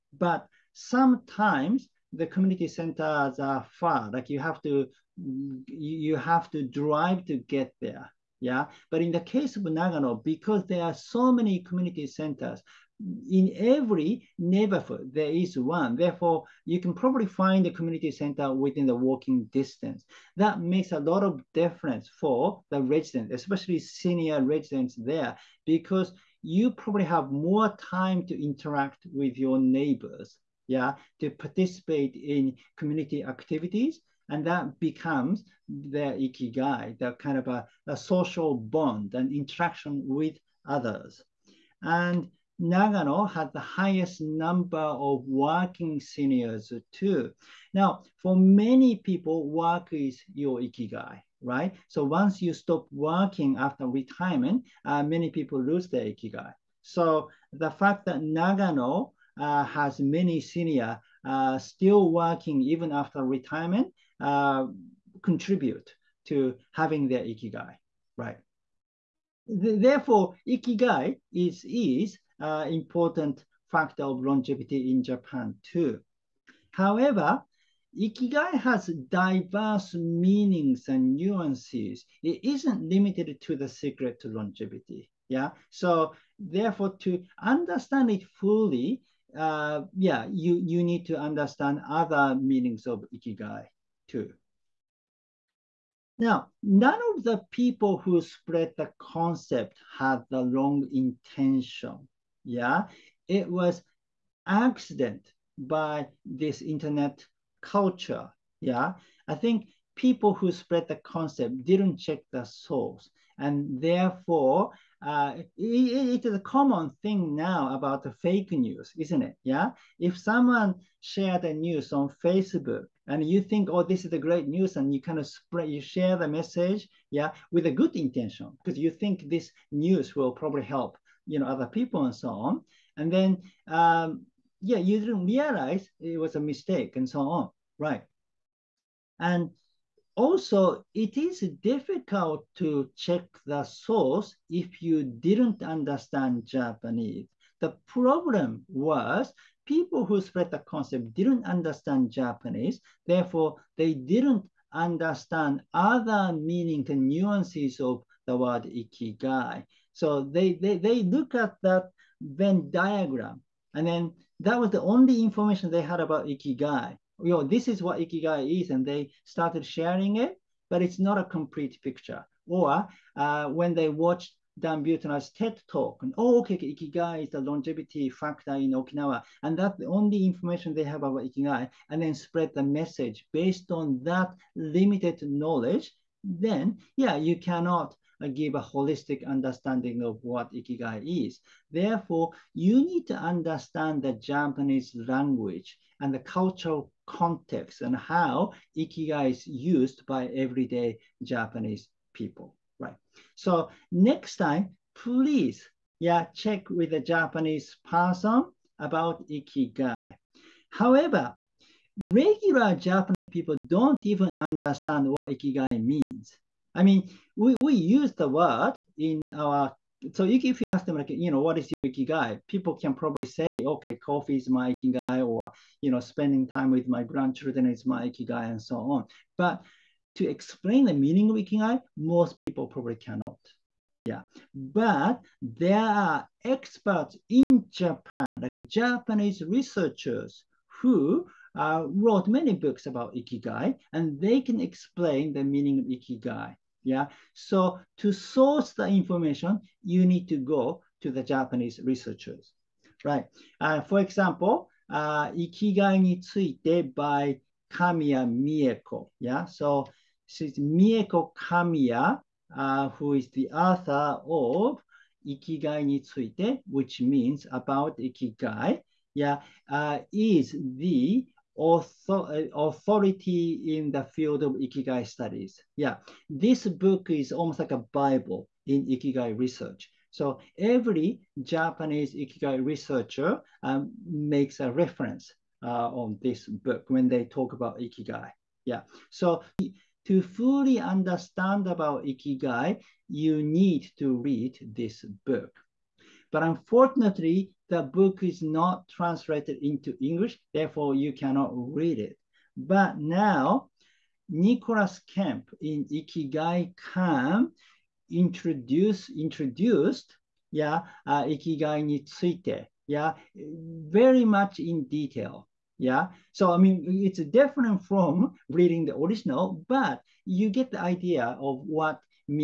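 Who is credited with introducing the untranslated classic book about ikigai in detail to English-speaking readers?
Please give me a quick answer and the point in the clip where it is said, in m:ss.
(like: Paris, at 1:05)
Nicholas Kemp, at 5:04.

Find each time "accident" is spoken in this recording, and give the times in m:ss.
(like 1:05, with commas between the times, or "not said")
1:44.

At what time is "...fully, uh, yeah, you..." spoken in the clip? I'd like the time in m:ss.
1:28.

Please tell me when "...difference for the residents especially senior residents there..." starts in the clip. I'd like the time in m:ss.
0:21.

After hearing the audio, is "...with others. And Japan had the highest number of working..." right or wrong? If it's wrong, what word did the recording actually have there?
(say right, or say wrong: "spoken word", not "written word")
wrong: "Nagano", not "Japan".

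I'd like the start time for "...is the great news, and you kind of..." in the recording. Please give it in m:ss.
2:04.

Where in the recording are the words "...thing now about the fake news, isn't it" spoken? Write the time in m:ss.
1:57.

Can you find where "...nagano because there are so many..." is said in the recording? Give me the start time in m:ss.
0:09.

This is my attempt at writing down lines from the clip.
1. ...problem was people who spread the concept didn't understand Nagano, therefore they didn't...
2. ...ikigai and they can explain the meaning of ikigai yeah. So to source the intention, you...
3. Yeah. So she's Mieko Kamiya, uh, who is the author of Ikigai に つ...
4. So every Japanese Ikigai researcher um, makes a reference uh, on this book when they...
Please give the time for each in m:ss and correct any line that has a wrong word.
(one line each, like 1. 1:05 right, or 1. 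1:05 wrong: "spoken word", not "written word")
1. 2:27 wrong: "Japanese", not "Nagano"
2. 4:03 wrong: "information", not "intention"
3. 4:19 right
4. 4:40 right.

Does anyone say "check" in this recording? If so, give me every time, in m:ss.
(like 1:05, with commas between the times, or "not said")
1:51, 2:22, 3:26.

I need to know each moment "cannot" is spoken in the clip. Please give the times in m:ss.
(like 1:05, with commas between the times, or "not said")
3:07, 3:52, 5:01.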